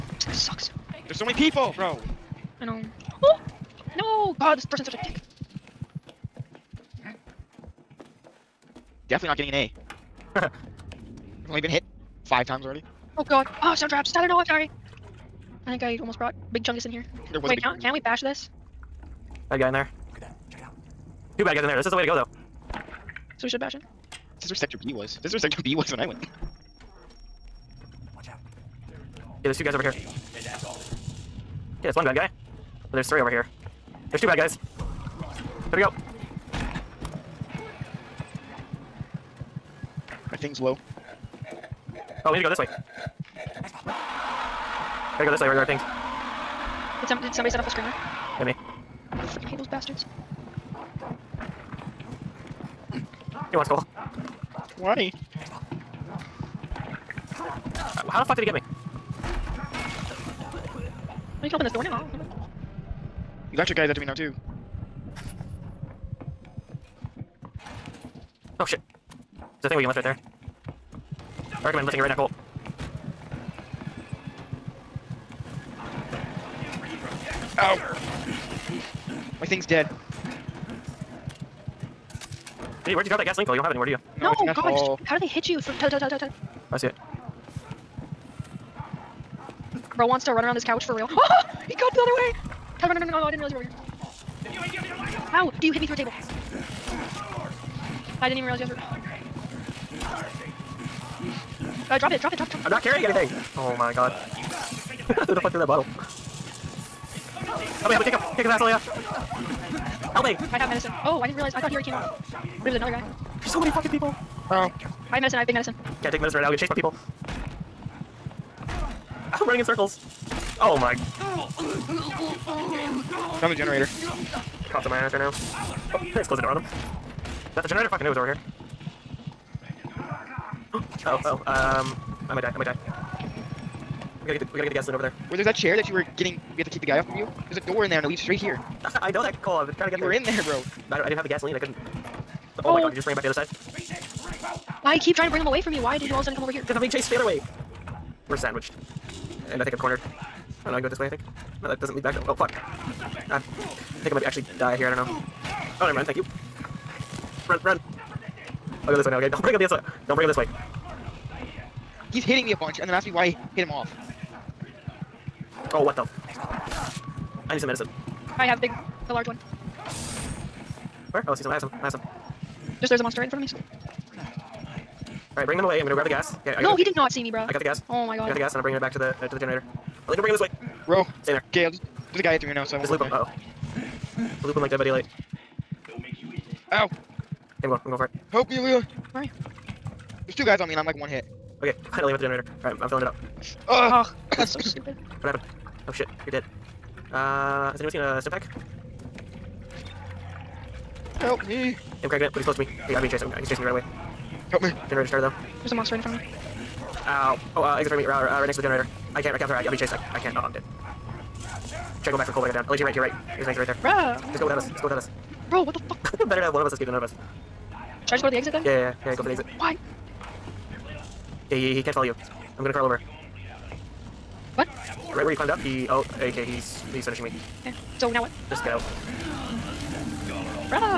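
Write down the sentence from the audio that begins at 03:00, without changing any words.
Oh, like, don't bring him this way.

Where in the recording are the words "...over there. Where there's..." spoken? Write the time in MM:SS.
02:14.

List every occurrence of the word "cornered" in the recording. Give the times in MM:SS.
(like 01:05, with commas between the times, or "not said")
02:29.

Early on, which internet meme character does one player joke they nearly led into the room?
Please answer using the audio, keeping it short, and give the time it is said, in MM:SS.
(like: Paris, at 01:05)
Big Chungus, at 00:16.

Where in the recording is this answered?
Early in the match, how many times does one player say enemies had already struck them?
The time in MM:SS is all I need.
00:12.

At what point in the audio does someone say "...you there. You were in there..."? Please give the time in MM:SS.
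02:19.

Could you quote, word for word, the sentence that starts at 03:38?
Should I just go to the exit then?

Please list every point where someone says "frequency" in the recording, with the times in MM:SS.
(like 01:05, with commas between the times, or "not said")
not said.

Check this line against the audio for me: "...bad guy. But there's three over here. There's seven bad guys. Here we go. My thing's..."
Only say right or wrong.
wrong.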